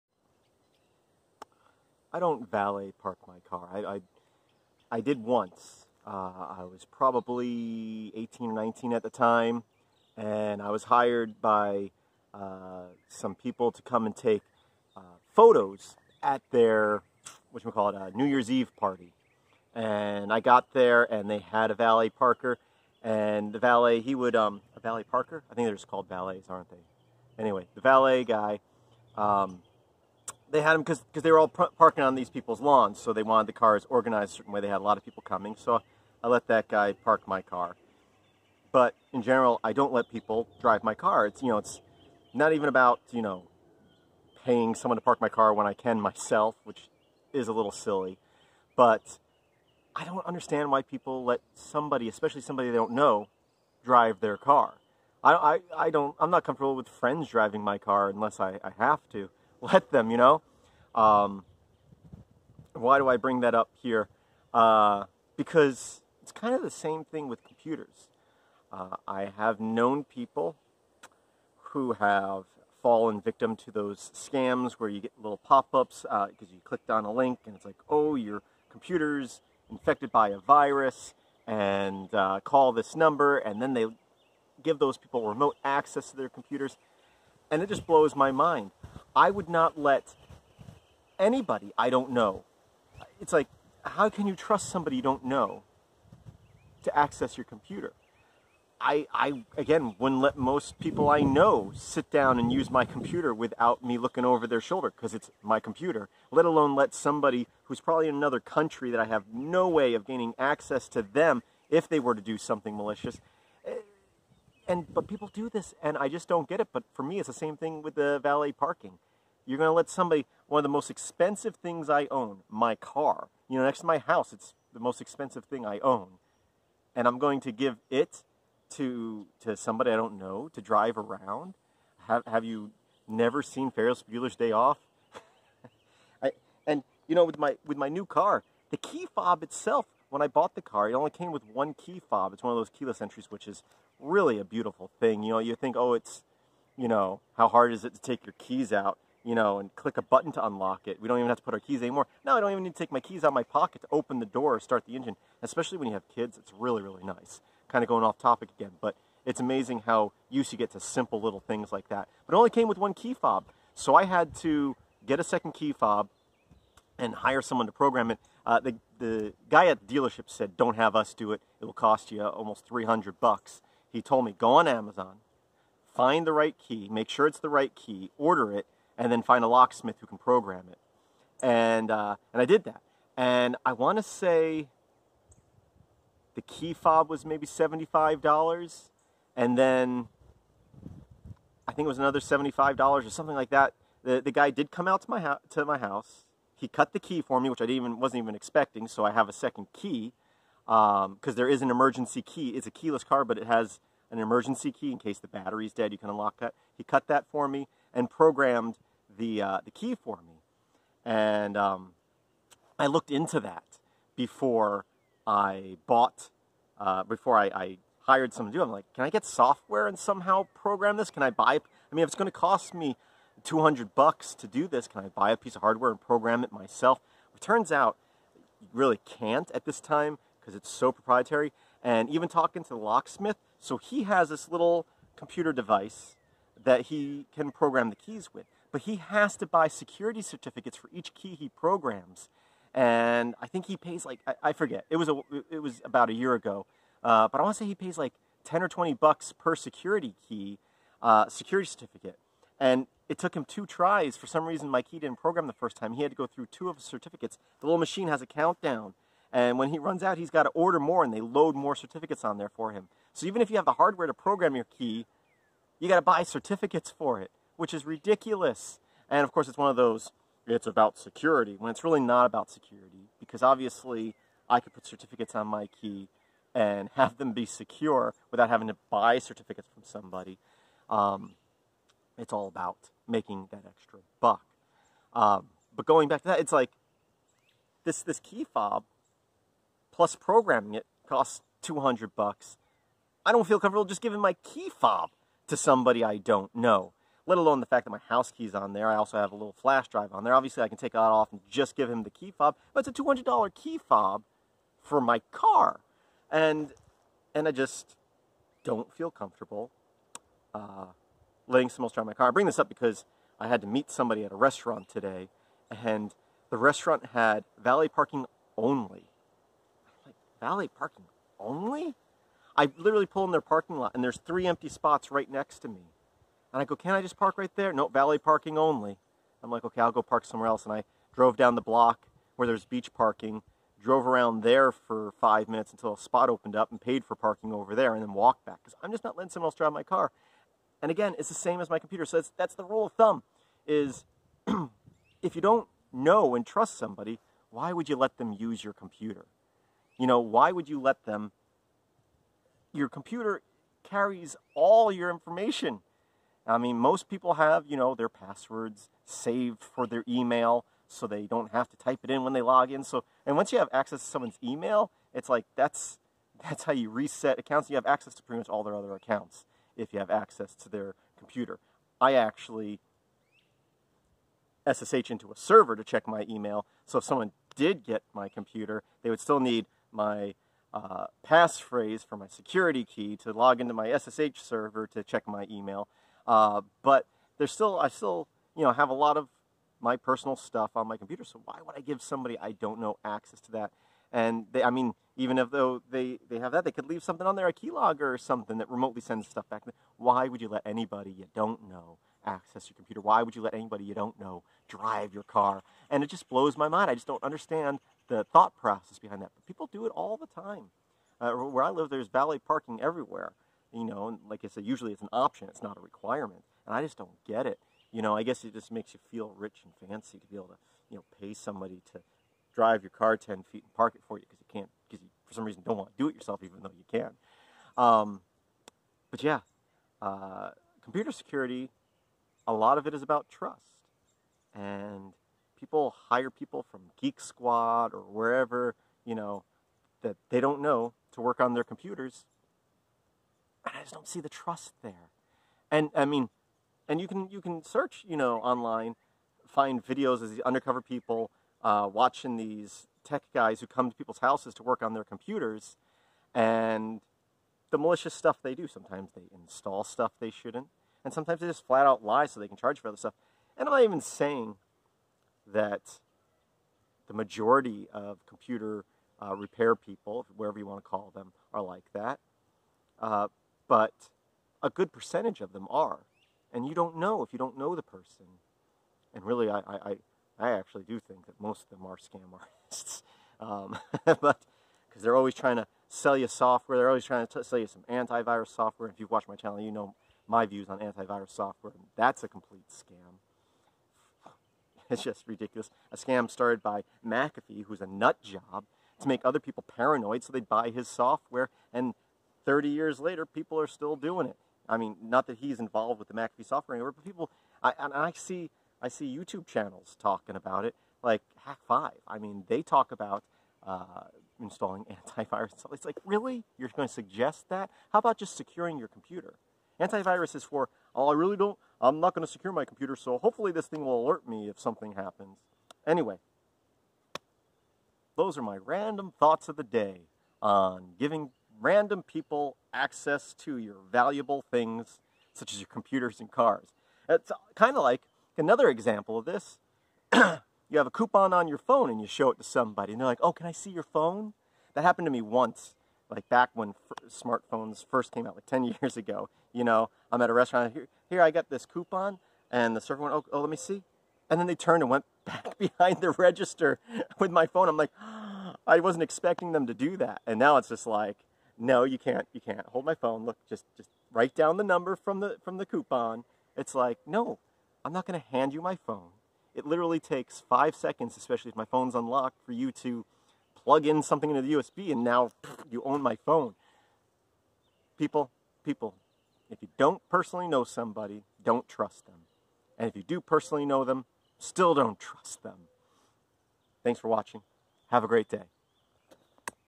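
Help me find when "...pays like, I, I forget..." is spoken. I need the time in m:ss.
4:03.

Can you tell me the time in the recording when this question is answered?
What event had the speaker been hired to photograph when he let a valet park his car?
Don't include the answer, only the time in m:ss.
0:18.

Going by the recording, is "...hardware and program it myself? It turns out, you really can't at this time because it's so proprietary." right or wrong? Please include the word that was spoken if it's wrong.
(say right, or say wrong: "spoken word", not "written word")
right.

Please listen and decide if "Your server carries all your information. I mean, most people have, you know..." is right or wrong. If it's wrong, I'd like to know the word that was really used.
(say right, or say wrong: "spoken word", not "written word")
wrong: "computer", not "server".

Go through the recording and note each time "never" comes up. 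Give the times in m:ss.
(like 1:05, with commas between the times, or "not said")
2:13.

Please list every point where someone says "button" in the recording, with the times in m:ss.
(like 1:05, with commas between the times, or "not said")
2:30.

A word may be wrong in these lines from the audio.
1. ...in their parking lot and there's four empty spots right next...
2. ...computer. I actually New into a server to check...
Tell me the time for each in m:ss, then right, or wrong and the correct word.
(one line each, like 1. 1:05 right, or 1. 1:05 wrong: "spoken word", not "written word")
1. 5:23 wrong: "three", not "four"
2. 6:11 wrong: "SSH", not "New".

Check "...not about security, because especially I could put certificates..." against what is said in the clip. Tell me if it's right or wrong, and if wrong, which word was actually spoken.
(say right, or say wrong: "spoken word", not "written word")
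wrong: "obviously", not "especially".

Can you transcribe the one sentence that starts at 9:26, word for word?
It's like, no, I'm not going to hand you my phone.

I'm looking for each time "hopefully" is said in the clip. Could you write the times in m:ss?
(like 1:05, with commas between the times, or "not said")
8:43.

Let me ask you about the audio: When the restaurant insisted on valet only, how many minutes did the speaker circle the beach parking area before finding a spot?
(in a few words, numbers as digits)
5.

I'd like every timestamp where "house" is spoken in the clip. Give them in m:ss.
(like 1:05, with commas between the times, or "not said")
2:03, 3:15, 4:58, 7:34.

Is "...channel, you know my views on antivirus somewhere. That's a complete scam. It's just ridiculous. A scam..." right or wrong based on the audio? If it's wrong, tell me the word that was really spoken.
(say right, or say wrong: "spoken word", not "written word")
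wrong: "software", not "somewhere".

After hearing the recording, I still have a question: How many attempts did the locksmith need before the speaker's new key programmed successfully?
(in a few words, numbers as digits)
2.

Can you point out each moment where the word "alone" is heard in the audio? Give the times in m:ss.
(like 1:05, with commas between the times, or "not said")
1:46, 4:57.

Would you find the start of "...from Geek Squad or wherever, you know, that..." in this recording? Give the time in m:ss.
7:16.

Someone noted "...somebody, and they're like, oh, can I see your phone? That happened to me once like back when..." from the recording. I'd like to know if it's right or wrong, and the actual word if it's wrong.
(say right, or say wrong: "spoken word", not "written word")
right.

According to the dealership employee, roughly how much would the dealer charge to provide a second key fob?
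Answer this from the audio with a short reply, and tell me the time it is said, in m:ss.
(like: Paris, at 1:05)
$300, at 2:52.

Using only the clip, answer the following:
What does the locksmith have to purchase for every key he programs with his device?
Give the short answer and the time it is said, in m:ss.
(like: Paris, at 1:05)
security certificates, at 3:59.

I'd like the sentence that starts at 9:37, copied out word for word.
People, people, if you don't personally know somebody, don't trust them.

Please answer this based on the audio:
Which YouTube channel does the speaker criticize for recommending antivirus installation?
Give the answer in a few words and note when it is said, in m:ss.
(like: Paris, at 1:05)
Hak5, at 8:31.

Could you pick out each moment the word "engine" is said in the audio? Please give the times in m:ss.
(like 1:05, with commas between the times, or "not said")
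2:34.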